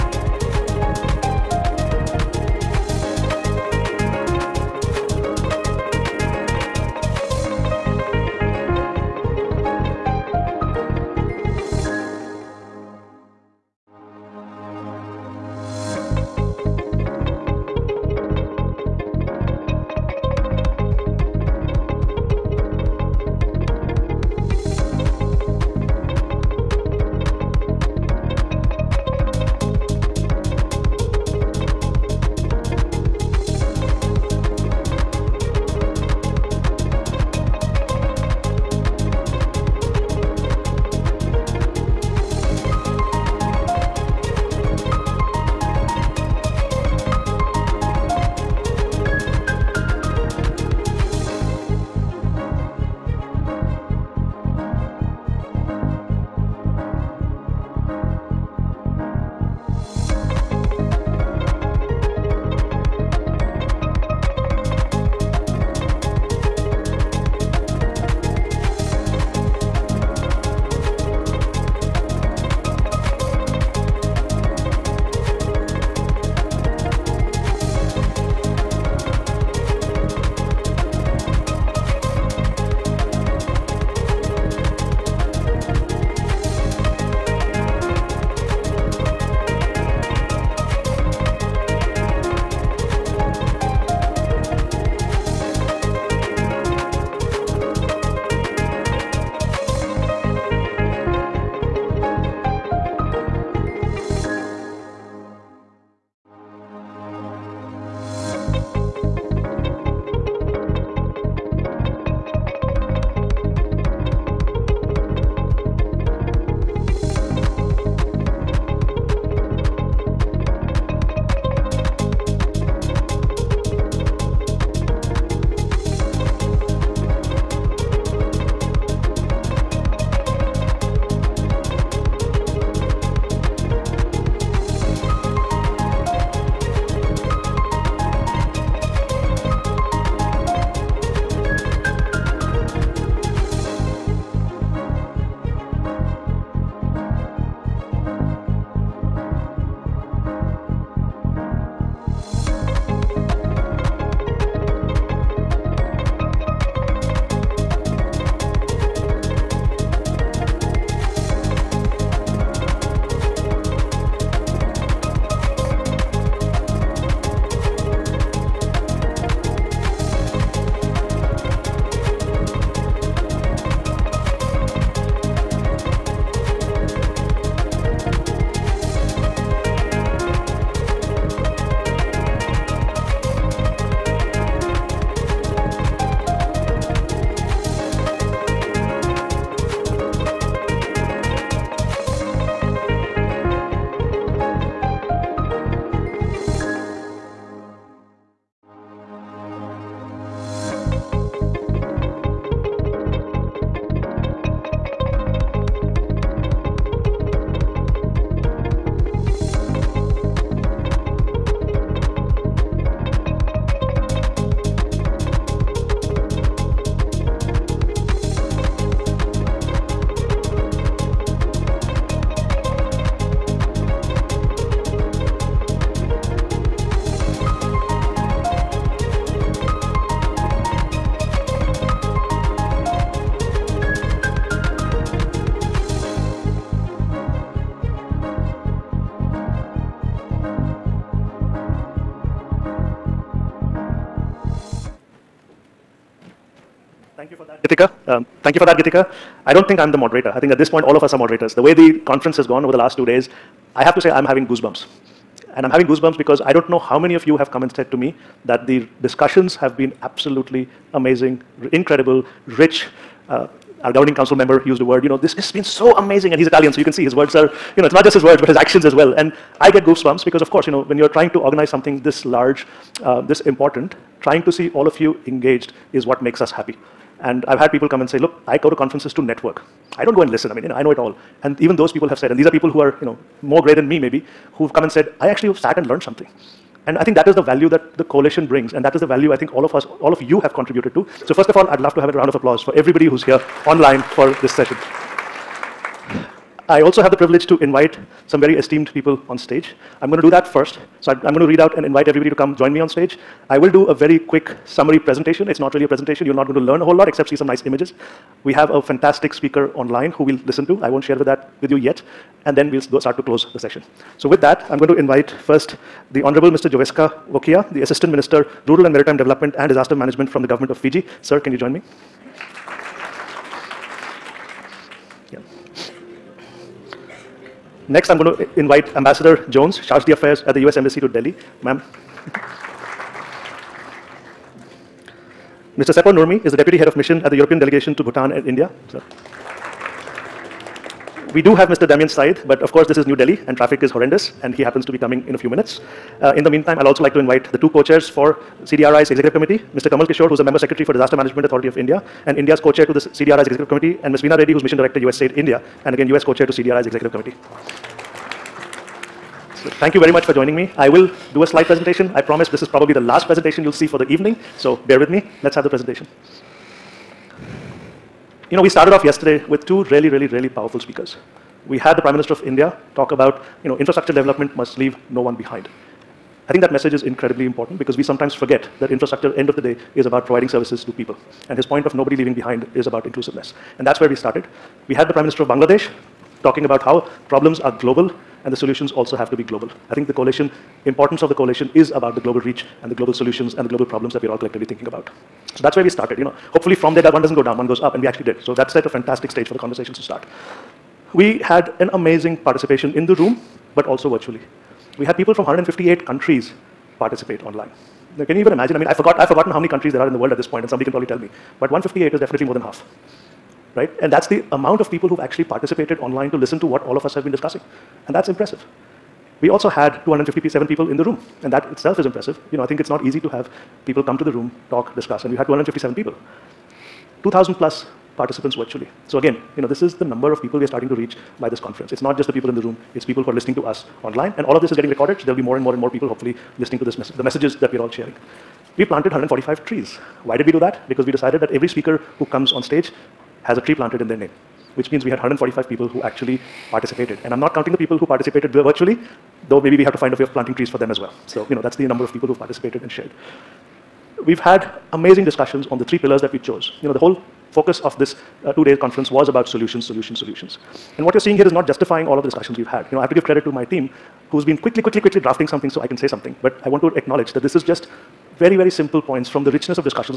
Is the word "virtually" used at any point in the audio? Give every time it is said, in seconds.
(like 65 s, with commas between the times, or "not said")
404 s, 428 s, 448 s.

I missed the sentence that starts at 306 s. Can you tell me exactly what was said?
You're not going to learn a whole lot except see some nice images.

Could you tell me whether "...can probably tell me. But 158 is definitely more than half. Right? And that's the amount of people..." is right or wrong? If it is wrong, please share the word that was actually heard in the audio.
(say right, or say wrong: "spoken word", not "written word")
right.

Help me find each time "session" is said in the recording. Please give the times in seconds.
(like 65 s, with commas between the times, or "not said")
294 s, 313 s.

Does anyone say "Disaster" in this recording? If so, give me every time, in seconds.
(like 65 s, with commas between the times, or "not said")
319 s, 350 s.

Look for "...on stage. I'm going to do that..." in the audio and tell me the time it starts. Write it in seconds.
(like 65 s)
299 s.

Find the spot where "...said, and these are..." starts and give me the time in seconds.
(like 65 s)
282 s.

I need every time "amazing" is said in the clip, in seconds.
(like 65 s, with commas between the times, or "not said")
260 s, 265 s, 401 s, 454 s.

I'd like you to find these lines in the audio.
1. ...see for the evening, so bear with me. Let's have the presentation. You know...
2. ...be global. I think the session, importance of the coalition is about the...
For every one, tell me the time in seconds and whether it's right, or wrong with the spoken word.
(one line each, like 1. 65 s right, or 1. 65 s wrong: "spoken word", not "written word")
1. 363 s right
2. 389 s wrong: "coalition", not "session".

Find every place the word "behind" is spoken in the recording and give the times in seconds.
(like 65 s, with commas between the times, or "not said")
375 s, 382 s.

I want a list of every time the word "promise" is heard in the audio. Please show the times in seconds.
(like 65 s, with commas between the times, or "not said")
362 s.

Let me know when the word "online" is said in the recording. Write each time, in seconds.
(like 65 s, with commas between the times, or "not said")
293 s, 309 s, 407 s, 415 s, 434 s.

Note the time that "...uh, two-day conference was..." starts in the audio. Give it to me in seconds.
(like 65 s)
458 s.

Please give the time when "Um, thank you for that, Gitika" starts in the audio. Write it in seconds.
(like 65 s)
248 s.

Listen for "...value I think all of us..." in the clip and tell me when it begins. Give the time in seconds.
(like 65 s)
289 s.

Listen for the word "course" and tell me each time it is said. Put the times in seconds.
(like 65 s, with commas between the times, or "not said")
270 s, 342 s.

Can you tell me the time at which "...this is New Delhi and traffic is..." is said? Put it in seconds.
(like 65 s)
342 s.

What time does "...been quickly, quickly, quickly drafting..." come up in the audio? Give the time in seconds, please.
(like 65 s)
464 s.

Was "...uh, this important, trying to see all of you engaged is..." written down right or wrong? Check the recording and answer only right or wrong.
right.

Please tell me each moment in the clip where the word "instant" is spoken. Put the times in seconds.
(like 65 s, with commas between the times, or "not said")
not said.